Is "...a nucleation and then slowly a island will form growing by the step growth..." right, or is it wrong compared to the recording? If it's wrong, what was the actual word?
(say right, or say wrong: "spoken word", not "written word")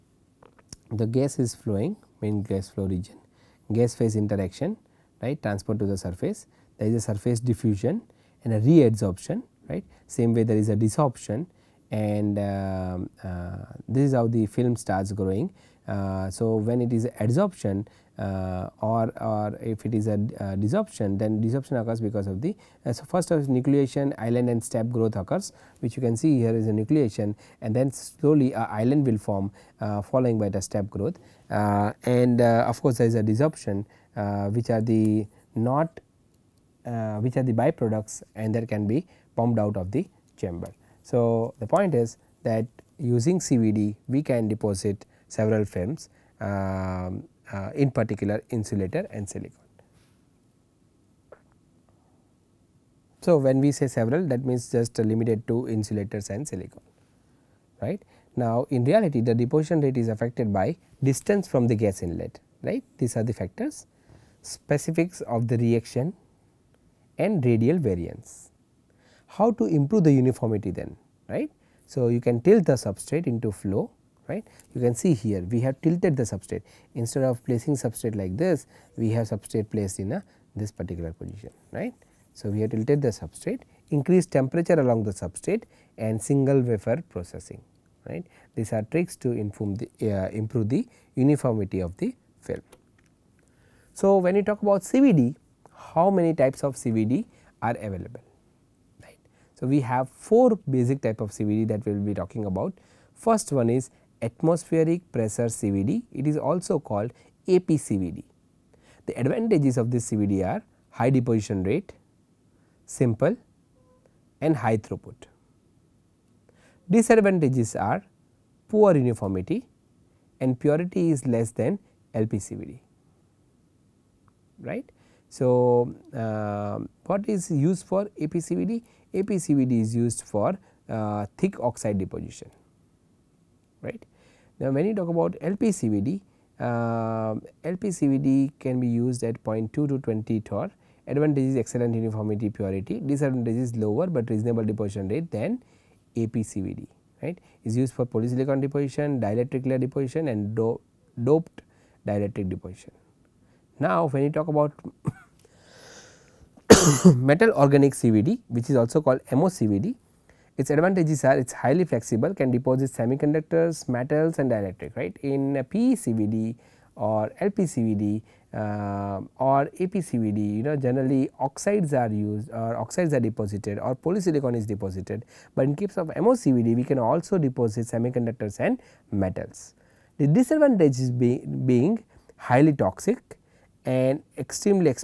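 wrong: "following", not "growing".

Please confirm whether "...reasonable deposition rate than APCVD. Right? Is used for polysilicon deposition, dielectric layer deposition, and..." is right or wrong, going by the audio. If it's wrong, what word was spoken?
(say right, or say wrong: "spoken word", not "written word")
right.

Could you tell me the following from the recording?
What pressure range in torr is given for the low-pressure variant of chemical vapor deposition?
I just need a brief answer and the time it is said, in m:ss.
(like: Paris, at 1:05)
0.2 to 20 torr, at 2:19.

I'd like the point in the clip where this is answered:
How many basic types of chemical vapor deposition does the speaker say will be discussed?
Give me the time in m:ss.
1:40.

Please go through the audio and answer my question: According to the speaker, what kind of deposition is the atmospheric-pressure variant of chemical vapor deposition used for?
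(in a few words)
Thick oxide deposition.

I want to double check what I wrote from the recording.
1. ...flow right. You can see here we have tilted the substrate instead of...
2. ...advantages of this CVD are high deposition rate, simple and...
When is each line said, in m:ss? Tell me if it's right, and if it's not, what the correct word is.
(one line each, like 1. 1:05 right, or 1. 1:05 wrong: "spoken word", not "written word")
1. 1:13 right
2. 1:49 right.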